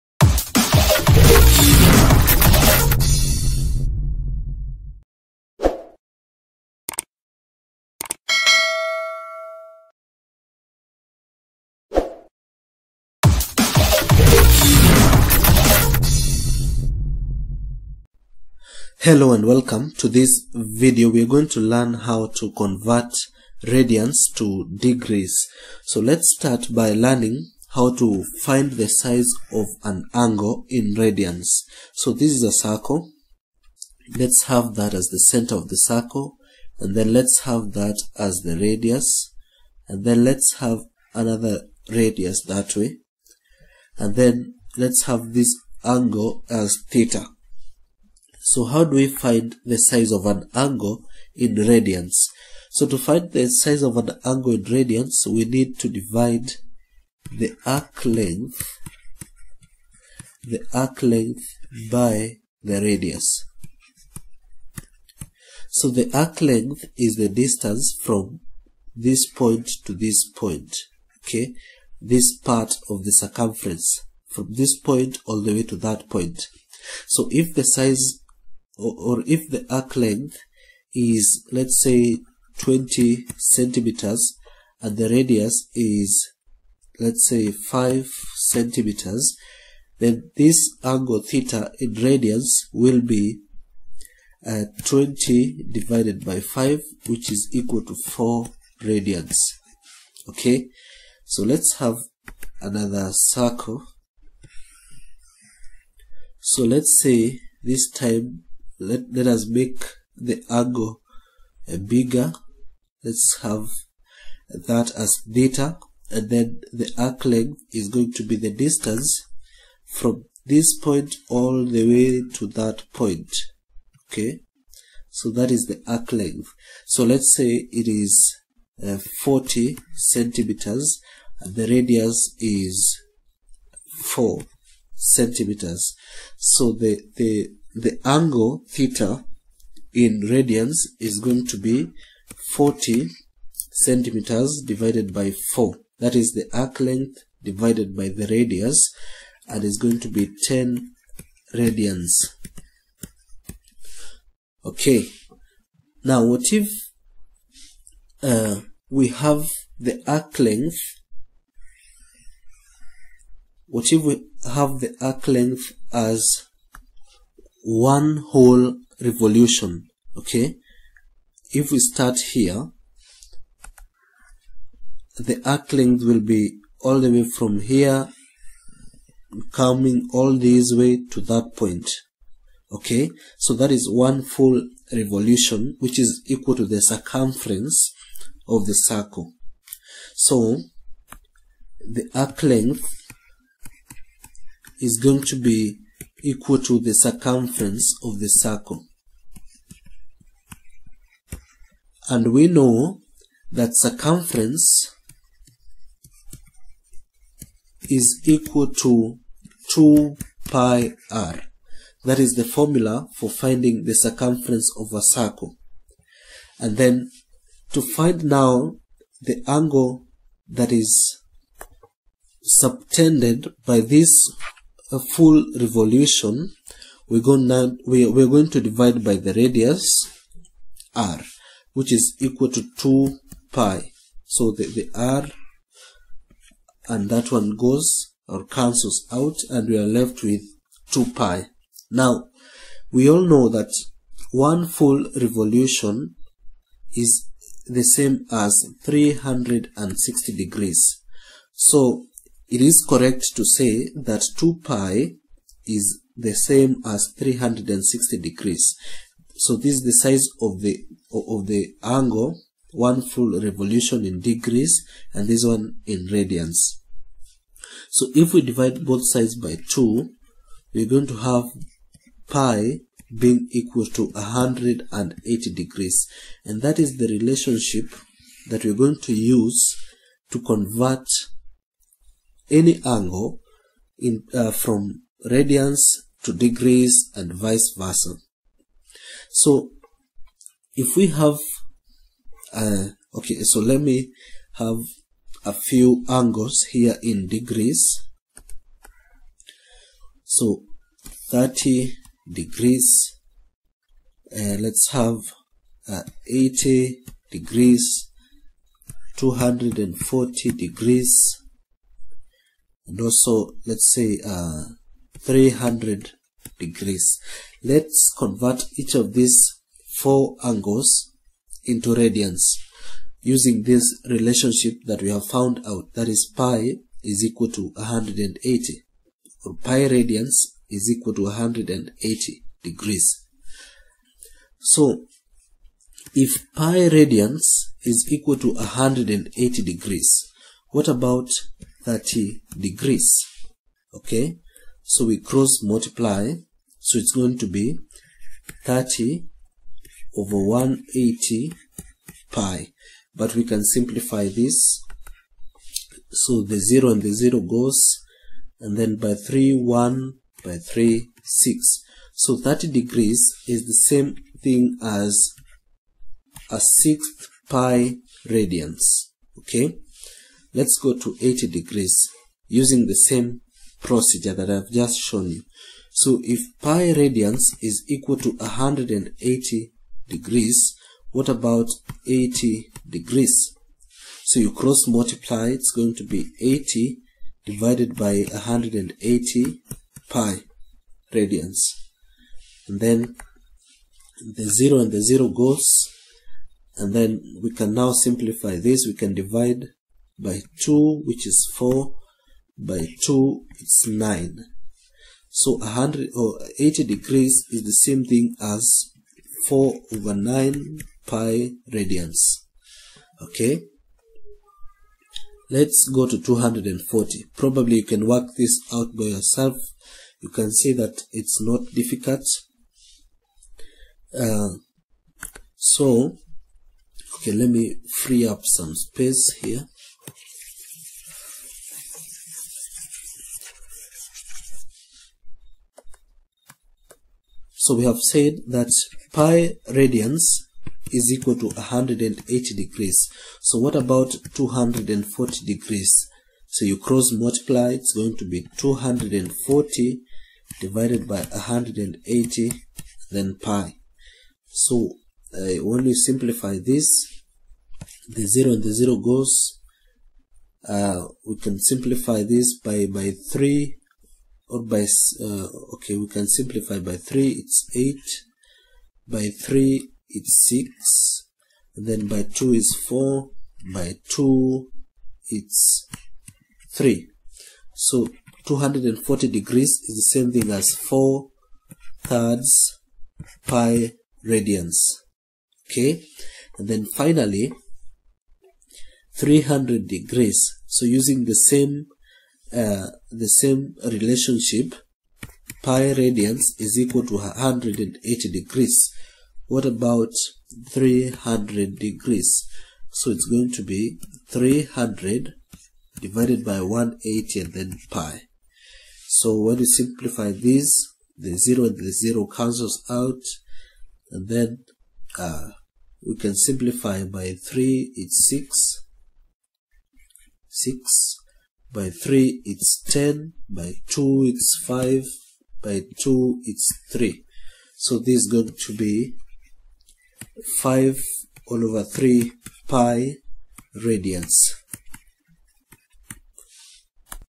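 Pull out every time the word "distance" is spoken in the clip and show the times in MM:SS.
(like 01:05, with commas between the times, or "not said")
01:07, 01:58.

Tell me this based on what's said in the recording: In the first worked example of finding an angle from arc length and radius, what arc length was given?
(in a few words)
20 centimeters.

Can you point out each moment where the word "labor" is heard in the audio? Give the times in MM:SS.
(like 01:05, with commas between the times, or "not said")
not said.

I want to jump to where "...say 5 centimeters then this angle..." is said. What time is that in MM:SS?
01:27.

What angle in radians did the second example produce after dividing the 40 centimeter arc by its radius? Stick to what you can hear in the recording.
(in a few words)
10 radians.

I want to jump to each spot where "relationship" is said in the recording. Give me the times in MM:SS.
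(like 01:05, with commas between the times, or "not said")
04:37, 05:24, 08:13.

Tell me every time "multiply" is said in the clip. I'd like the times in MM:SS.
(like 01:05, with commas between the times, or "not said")
05:45, 06:24, 07:27.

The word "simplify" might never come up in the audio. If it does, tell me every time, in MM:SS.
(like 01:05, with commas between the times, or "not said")
05:53, 06:37, 07:35, 07:41, 07:46, 08:29, 08:36.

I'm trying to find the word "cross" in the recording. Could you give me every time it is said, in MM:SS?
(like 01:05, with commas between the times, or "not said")
05:45, 06:24, 07:26.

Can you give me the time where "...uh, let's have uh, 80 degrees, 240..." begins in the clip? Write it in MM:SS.
05:04.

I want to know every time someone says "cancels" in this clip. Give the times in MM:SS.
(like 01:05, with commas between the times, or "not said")
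03:58, 08:32.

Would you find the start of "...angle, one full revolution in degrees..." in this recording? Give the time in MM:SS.
04:21.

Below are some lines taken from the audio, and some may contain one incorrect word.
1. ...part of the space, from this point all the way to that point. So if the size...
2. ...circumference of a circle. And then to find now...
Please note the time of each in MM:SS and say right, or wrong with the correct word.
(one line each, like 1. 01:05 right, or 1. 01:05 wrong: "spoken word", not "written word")
1. 01:12 wrong: "circumference", not "space"
2. 03:33 right.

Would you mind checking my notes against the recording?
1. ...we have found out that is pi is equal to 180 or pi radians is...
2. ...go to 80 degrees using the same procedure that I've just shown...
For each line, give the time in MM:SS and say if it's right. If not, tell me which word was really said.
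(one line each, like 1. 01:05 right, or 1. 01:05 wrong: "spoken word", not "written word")
1. 05:25 right
2. 06:10 right.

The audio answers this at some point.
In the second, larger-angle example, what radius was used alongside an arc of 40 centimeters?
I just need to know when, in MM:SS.
02:14.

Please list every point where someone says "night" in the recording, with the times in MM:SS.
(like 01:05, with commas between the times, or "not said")
not said.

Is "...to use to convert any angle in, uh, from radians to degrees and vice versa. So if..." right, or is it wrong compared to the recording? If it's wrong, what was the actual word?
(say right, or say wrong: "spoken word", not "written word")
right.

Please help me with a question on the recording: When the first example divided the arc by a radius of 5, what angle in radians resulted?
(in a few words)
4 radians.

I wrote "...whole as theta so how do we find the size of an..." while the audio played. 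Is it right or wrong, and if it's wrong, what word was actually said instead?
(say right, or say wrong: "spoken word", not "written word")
wrong: "angle", not "whole".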